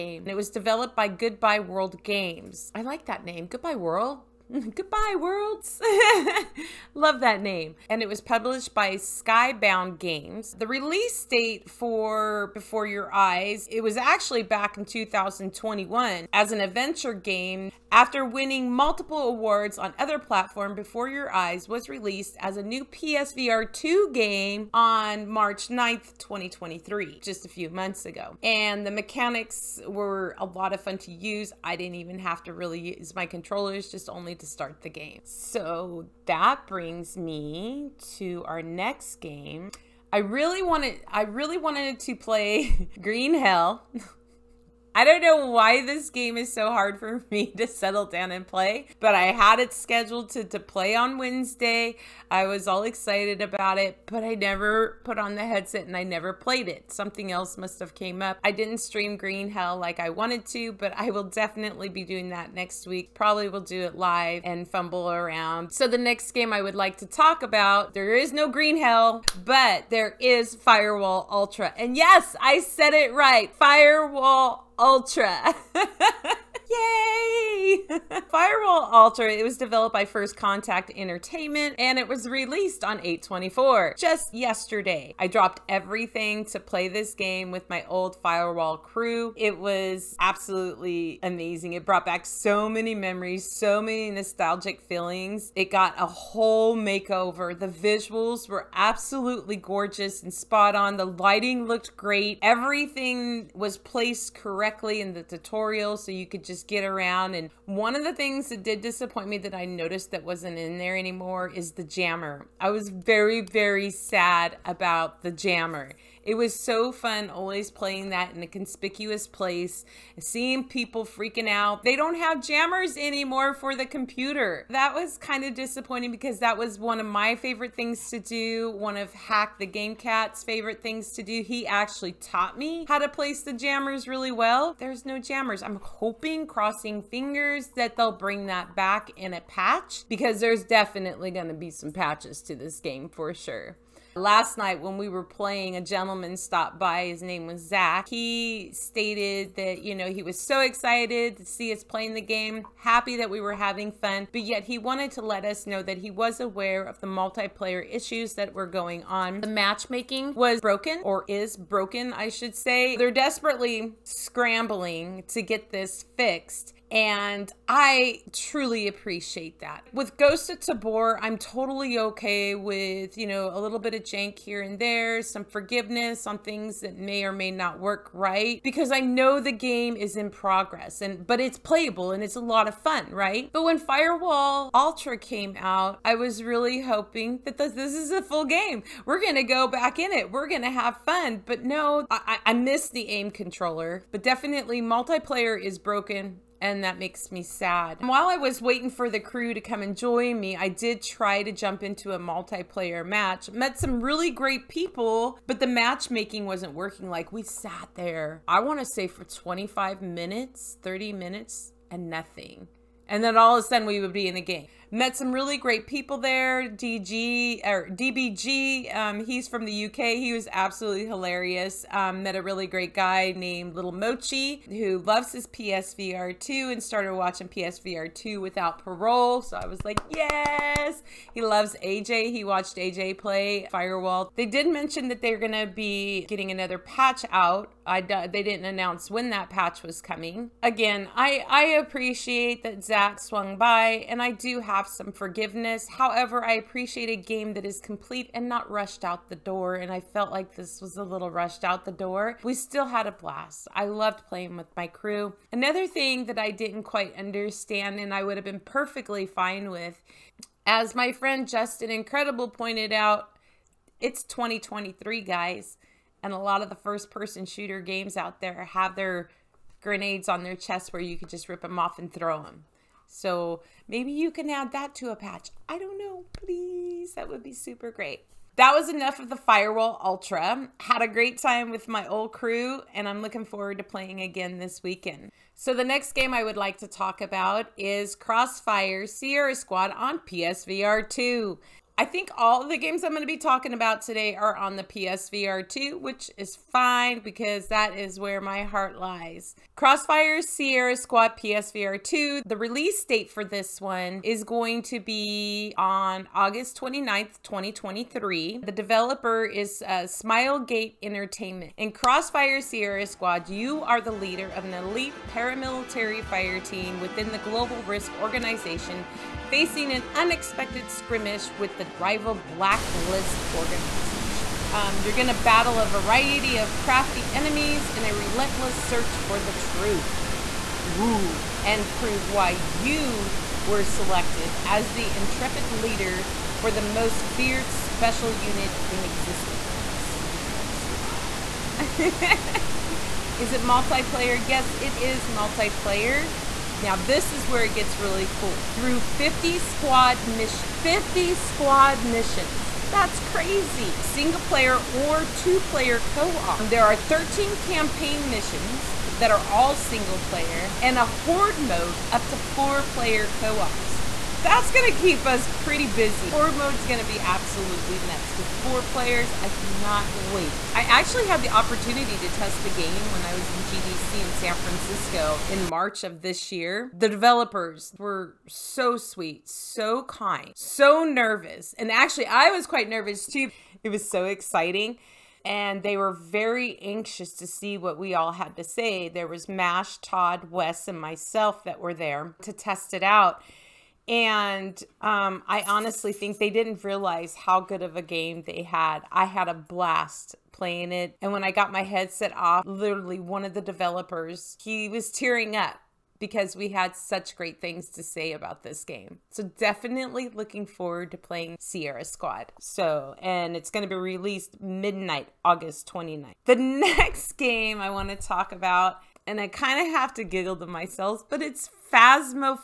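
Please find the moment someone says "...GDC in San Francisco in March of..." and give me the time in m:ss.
6:13.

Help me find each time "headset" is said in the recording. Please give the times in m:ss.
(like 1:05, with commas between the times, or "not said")
0:55, 6:41.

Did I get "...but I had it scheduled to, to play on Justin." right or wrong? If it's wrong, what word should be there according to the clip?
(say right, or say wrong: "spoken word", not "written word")
wrong: "Wednesday", not "Justin".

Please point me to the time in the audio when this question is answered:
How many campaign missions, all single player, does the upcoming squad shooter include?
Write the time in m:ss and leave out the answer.
5:56.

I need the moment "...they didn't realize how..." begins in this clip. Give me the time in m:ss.
6:36.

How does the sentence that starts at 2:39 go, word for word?
The matchmaking was broken or is broken, I should say.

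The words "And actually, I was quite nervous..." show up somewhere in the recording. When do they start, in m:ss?
6:21.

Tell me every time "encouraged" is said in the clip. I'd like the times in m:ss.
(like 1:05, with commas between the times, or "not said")
not said.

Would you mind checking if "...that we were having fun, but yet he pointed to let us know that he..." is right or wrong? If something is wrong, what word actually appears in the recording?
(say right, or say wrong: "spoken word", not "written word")
wrong: "wanted", not "pointed".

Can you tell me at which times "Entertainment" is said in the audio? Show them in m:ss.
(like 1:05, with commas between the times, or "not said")
1:20, 5:11.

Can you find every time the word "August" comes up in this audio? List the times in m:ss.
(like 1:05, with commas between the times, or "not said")
5:06, 6:55.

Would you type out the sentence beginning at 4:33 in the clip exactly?
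So maybe you can add that to a patch.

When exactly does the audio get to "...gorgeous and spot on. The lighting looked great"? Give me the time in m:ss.
1:39.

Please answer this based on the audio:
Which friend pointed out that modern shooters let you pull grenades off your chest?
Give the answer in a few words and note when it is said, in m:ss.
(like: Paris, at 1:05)
Justin Incredible, at 4:21.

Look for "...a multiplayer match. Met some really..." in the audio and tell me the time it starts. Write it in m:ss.
3:22.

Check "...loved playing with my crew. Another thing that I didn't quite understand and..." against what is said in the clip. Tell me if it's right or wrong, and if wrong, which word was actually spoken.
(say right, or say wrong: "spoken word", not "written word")
right.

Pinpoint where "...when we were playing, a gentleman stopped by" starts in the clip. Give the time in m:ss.
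2:24.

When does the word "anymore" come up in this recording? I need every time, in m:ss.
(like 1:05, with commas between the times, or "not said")
1:50, 2:02.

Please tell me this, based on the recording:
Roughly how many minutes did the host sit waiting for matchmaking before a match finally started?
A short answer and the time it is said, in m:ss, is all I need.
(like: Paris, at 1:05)
25 minutes, at 3:29.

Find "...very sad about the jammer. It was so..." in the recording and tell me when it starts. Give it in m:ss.
1:53.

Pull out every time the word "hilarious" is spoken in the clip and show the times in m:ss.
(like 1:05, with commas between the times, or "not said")
3:41.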